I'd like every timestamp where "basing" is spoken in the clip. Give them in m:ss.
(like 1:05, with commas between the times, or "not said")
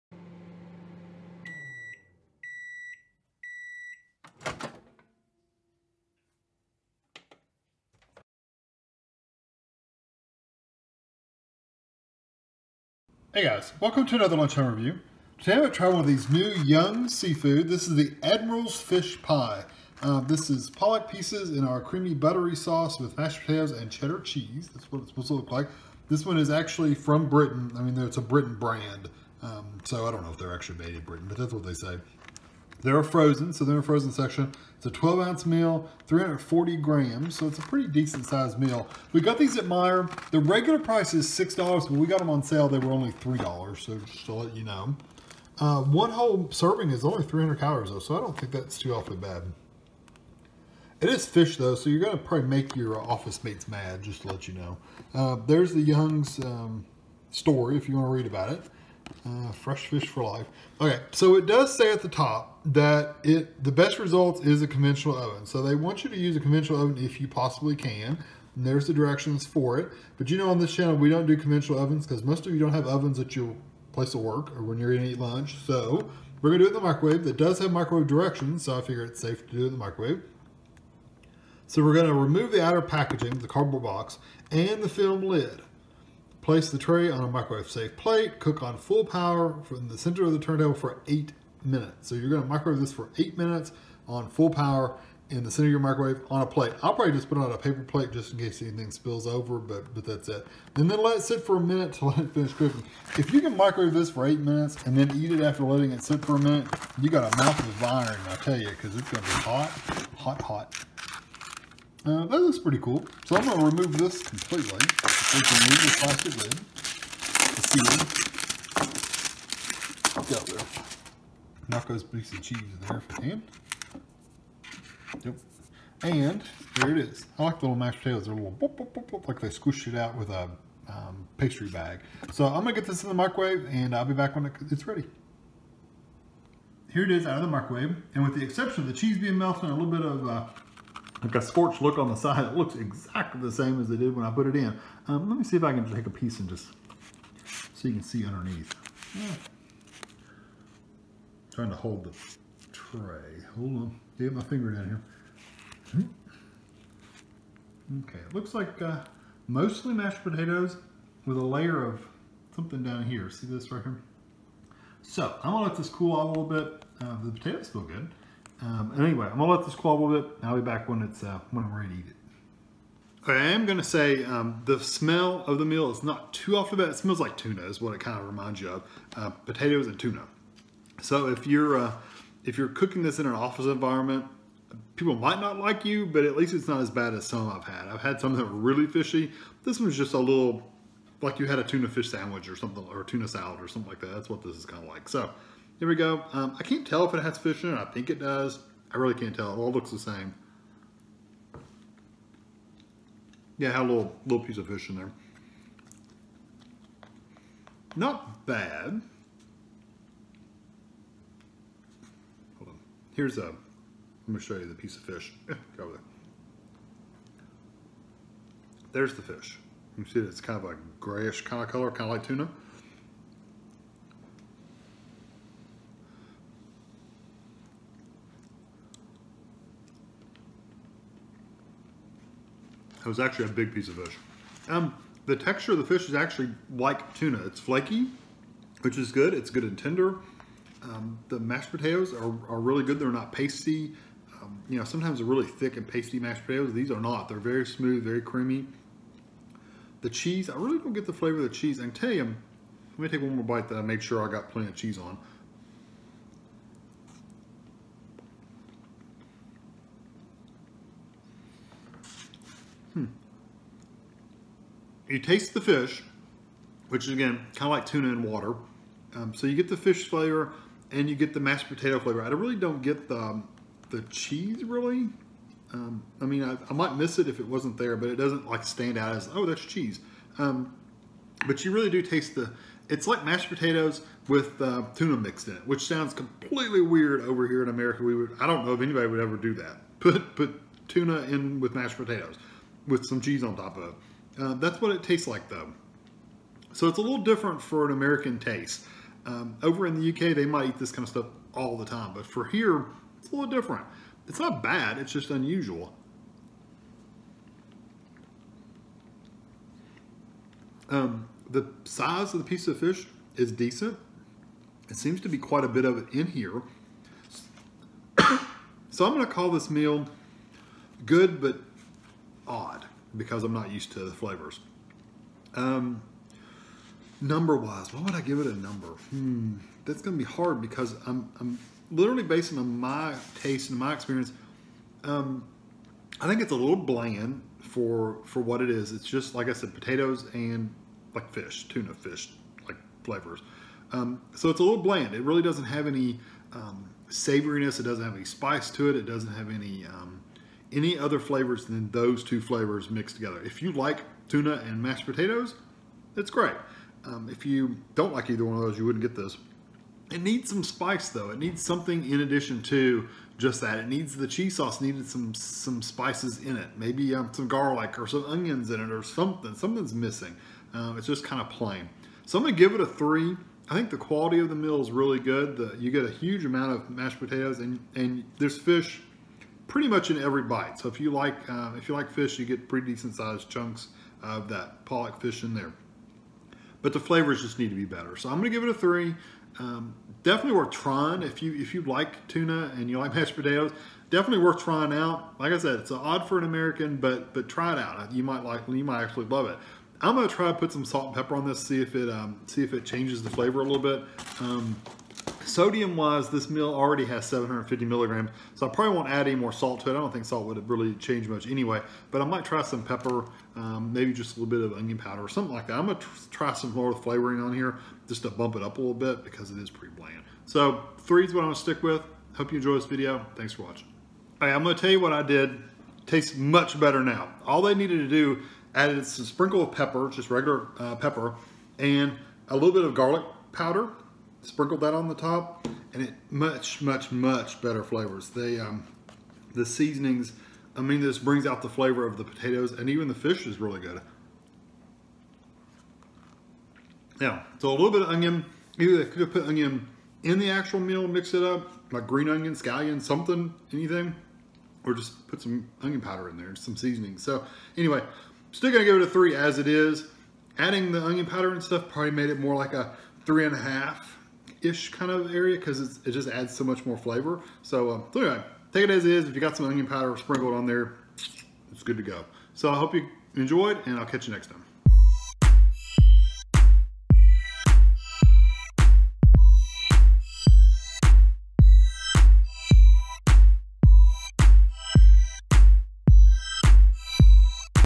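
5:32.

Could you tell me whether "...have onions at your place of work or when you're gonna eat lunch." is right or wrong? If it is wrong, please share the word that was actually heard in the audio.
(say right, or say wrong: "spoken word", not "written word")
wrong: "ovens", not "onions".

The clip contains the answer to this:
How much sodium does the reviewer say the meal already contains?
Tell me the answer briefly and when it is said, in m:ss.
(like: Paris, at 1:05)
750 milligrams, at 6:47.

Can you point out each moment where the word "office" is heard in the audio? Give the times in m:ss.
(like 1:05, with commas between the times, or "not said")
0:52, 3:03.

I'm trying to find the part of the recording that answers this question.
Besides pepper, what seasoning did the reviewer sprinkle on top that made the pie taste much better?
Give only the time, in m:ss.
7:12.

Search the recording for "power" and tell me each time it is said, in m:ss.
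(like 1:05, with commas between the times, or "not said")
1:29, 1:34.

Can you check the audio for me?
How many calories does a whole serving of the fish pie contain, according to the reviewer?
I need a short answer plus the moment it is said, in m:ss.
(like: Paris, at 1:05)
300, at 0:47.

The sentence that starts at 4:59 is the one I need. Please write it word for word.
Um, over in the UK, they might eat this kind of stuff all the time, but for here, it's a little different.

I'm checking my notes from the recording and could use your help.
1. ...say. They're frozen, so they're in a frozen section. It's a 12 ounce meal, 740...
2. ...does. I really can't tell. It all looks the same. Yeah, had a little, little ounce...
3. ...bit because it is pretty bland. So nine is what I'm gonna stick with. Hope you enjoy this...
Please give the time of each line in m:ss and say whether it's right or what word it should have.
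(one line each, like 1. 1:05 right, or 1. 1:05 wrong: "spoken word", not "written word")
1. 0:31 wrong: "340", not "740"
2. 3:18 wrong: "piece", not "ounce"
3. 6:58 wrong: "three", not "nine".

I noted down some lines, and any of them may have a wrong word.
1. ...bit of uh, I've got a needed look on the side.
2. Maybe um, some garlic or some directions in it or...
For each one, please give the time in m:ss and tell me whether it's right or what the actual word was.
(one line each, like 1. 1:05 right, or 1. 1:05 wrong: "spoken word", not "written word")
1. 2:19 wrong: "scorched", not "needed"
2. 6:06 wrong: "onions", not "directions".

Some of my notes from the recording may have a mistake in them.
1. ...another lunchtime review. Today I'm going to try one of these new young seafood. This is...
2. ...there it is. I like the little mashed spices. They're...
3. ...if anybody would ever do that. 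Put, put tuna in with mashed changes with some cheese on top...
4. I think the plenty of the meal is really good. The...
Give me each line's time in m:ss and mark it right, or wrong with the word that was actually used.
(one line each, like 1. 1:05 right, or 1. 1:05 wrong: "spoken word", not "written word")
1. 0:14 right
2. 2:06 wrong: "potatoes", not "spices"
3. 4:48 wrong: "potatoes", not "changes"
4. 6:13 wrong: "quality", not "plenty".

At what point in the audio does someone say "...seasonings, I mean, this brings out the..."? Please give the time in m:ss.
7:19.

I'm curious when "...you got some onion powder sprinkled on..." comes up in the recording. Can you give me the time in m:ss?
7:49.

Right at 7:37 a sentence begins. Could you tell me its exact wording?
So anyway, still gonna give it a three as it is.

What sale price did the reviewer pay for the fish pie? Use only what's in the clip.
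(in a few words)
$3.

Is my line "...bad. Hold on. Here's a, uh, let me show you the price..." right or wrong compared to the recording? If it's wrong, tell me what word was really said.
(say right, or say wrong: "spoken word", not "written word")
wrong: "piece", not "price".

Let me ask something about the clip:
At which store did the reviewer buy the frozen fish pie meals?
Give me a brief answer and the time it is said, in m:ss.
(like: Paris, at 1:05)
Meijer, at 0:39.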